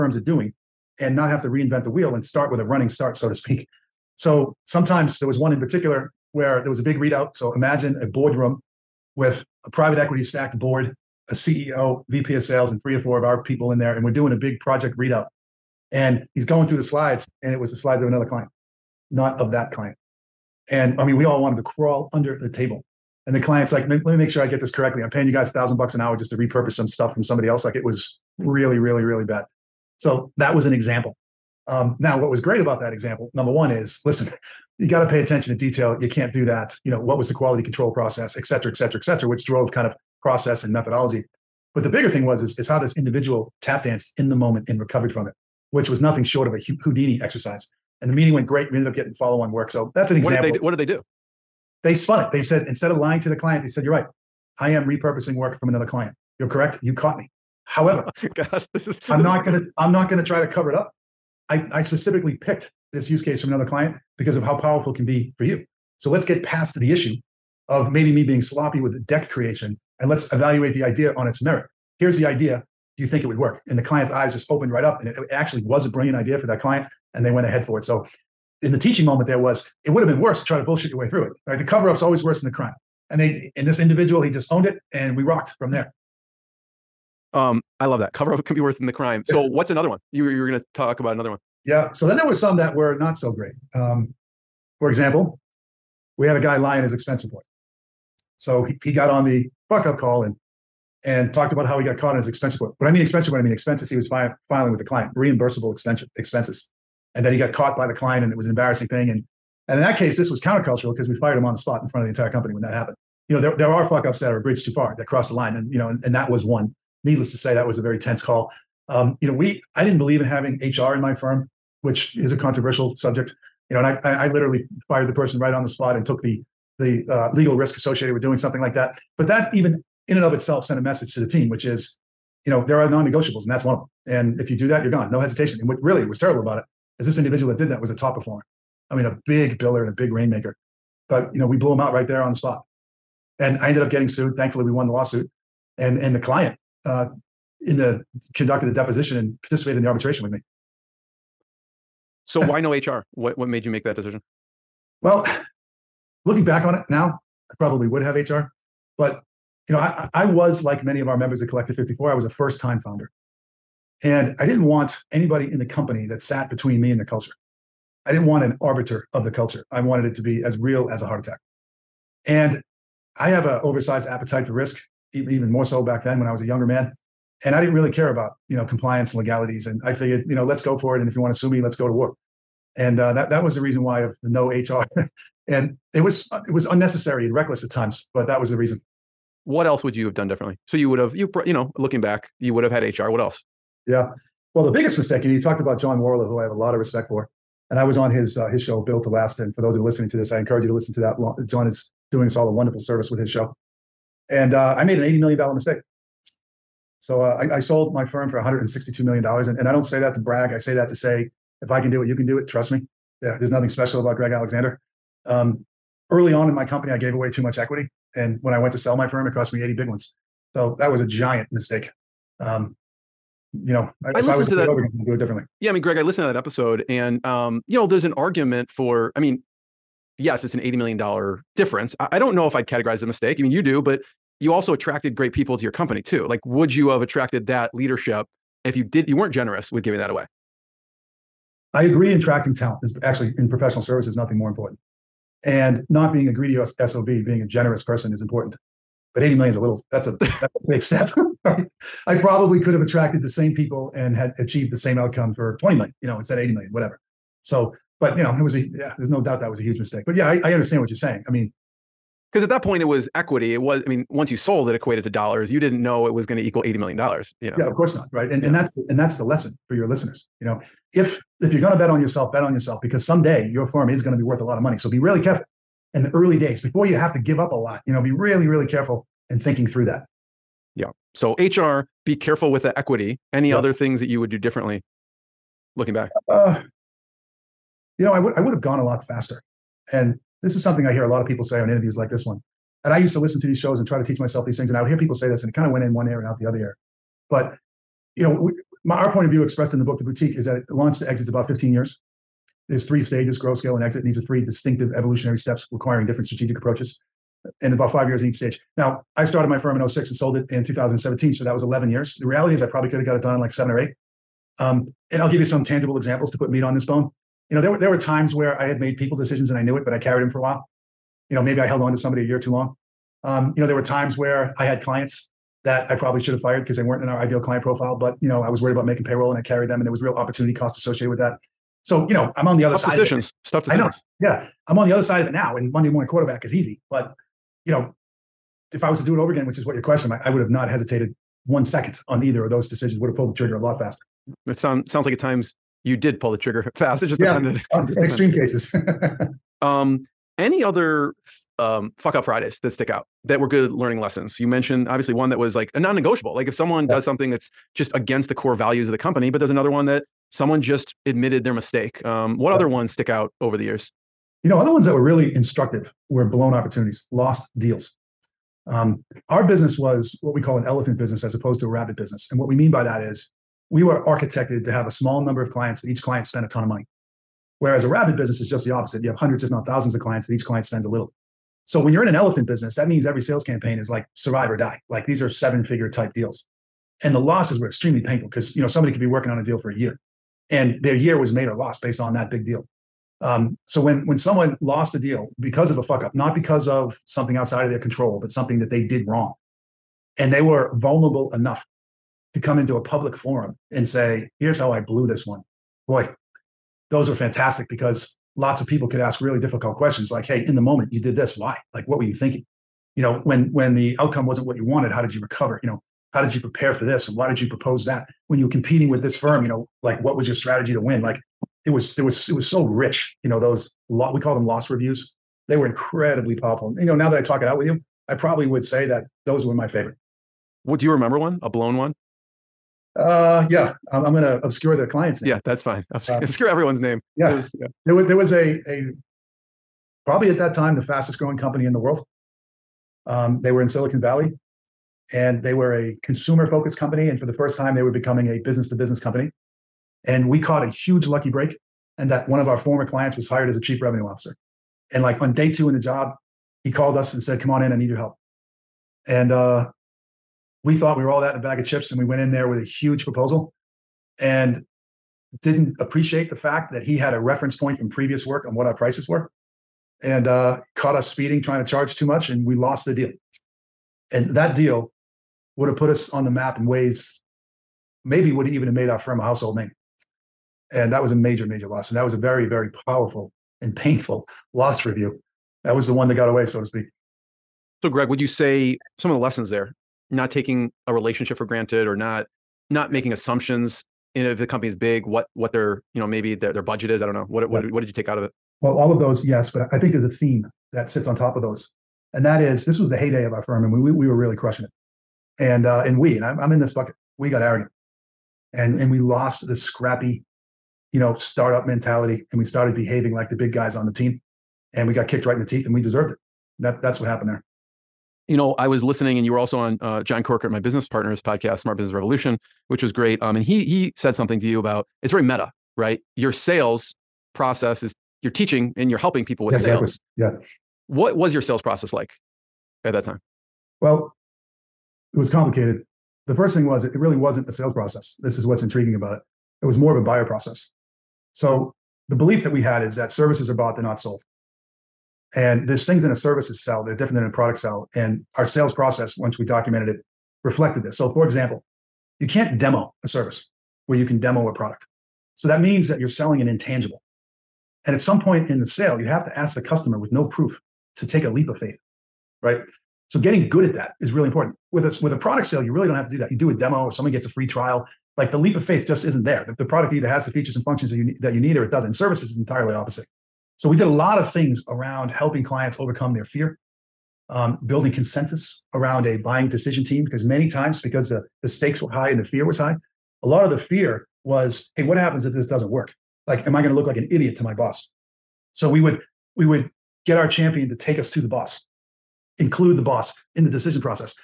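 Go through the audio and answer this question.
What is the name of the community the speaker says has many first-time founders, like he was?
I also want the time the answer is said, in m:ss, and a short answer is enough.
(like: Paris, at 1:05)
Collective 54, at 2:41.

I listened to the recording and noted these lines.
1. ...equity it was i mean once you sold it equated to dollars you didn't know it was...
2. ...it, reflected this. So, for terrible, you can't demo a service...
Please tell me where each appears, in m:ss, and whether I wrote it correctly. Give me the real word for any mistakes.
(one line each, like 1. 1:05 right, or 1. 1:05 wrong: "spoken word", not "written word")
1. 4:23 right
2. 9:09 wrong: "example", not "terrible".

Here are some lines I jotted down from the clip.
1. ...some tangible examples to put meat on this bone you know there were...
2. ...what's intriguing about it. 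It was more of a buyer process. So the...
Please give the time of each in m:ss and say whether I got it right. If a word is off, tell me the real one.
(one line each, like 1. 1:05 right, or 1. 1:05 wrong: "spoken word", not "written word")
1. 5:15 right
2. 8:58 right.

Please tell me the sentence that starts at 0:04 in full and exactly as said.
So sometimes there was one in particular where there was a big readout.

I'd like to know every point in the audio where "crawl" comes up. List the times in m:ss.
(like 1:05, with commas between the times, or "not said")
0:21.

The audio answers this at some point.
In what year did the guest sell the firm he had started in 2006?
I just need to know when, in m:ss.
5:10.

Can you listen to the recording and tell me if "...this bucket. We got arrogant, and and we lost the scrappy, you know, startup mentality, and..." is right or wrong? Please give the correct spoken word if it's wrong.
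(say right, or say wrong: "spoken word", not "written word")
right.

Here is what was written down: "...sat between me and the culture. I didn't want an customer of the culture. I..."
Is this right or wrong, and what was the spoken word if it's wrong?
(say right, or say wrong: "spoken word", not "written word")
wrong: "arbiter", not "customer".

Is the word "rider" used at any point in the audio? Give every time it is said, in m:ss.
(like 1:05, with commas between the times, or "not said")
not said.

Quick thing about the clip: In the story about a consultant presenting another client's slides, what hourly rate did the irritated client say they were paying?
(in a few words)
$1,000 an hour.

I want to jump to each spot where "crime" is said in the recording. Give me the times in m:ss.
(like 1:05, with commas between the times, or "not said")
1:22, 1:28.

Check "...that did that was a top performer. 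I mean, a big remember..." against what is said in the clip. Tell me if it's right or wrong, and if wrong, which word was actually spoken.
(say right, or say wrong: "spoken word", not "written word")
wrong: "biller", not "remember".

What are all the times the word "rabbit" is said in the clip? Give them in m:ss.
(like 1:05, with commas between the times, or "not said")
6:11, 6:17.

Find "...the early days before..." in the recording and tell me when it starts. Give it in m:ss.
4:36.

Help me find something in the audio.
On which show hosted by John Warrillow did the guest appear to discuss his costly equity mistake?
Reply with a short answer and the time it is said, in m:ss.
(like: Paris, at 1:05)
Built to Last, at 3:18.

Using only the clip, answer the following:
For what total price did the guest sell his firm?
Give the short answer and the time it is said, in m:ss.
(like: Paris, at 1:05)
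$162 million, at 3:28.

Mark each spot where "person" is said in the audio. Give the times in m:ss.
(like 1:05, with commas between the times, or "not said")
2:05, 4:07.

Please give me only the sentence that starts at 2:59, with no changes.
And I figured, you know, let's go for it.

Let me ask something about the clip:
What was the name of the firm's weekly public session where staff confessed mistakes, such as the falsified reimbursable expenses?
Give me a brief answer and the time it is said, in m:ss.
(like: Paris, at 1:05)
Fuck up call, at 1:39.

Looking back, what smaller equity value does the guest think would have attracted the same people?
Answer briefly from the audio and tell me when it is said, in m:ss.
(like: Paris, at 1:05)
$20 million, at 4:15.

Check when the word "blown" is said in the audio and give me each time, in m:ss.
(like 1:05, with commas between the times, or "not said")
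6:06, 7:11.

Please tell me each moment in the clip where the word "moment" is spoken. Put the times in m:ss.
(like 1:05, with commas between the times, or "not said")
0:44, 1:19, 6:50.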